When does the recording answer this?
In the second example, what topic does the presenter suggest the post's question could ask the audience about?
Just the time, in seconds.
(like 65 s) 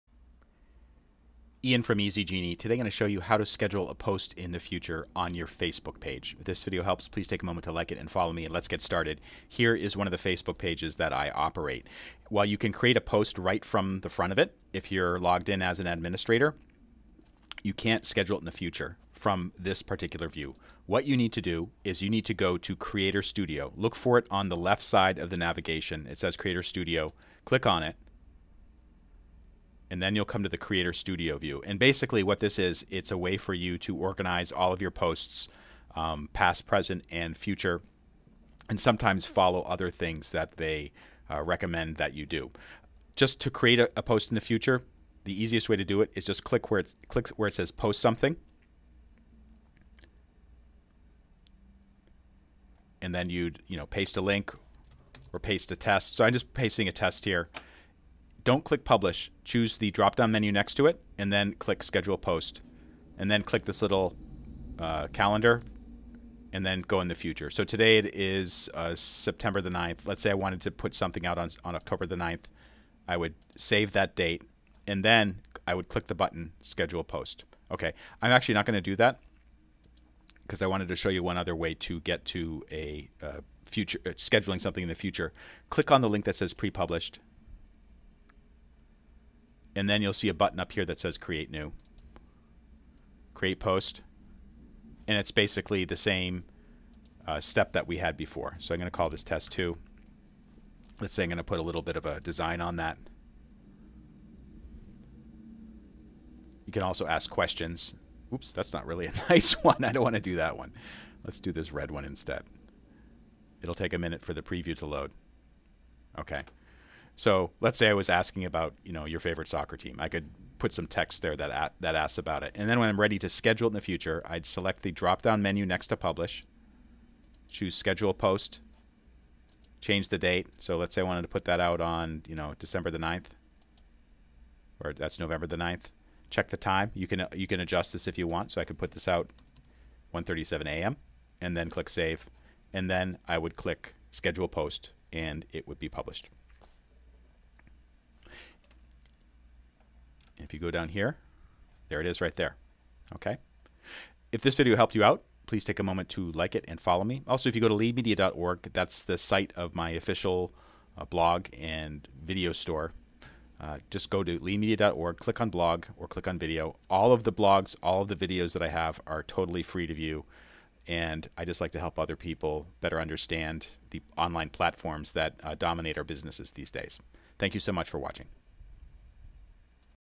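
119 s.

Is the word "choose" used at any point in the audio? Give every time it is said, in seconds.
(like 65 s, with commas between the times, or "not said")
59 s, 127 s.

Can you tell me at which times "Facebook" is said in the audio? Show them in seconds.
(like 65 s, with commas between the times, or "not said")
5 s, 10 s.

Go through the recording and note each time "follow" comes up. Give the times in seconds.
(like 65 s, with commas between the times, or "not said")
8 s, 39 s, 156 s.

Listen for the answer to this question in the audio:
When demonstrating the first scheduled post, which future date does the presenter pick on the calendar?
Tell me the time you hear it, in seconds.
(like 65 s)
71 s.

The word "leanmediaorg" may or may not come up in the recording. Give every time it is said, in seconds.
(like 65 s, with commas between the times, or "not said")
157 s, 164 s.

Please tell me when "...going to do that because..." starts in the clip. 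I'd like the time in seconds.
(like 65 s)
78 s.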